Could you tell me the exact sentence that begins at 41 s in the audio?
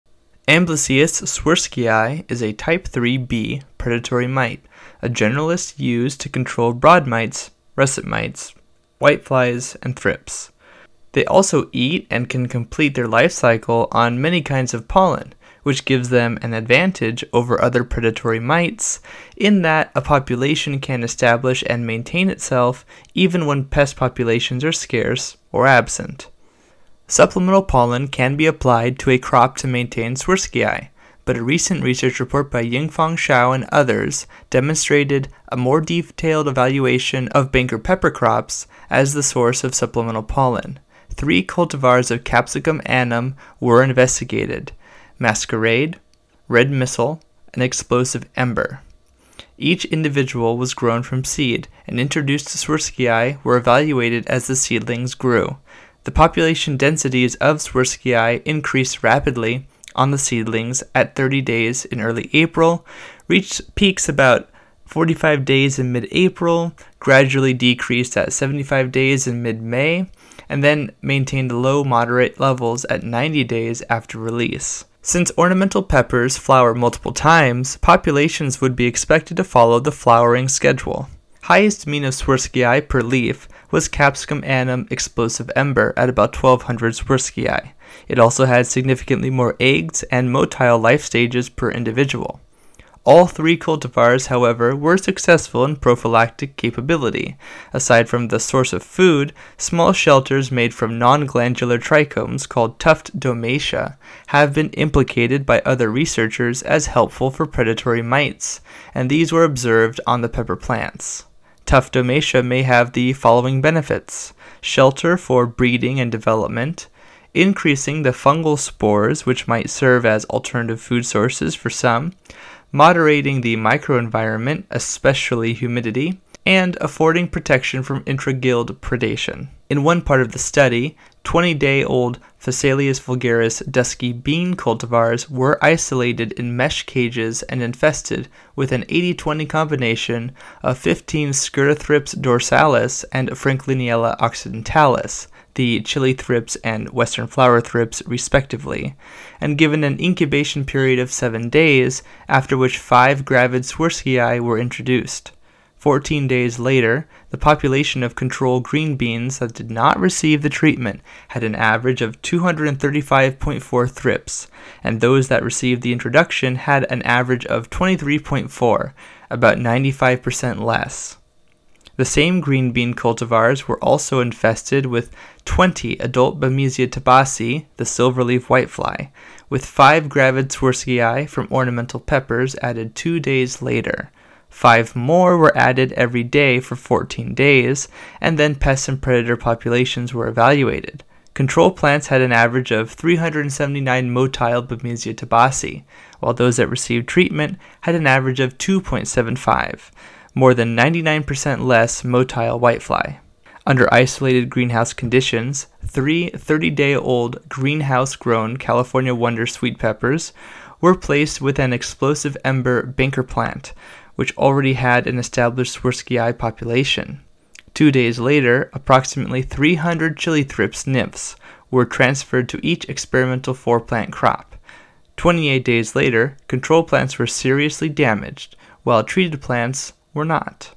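Three cultivars of Capsicum annuum were investigated Masquerade, Red Missile, and Explosive Ember.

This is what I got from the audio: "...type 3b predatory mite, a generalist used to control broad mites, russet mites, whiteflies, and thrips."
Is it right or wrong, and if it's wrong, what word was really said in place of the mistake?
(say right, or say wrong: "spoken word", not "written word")
right.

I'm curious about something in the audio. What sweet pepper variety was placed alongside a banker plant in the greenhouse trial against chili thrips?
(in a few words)
California Wonder.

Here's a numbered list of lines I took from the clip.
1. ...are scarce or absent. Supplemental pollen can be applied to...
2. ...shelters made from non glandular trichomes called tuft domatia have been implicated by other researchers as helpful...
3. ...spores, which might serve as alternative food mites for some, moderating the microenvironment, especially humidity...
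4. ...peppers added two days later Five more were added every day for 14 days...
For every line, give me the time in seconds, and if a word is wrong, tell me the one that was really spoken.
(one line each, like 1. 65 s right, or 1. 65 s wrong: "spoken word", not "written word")
1. 24 s right
2. 99 s right
3. 118 s wrong: "sources", not "mites"
4. 181 s right.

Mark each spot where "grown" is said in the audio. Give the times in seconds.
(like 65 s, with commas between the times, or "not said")
50 s, 208 s.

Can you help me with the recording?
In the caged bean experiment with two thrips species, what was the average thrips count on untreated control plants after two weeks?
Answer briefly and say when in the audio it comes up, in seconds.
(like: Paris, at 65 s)
235.4, at 162 s.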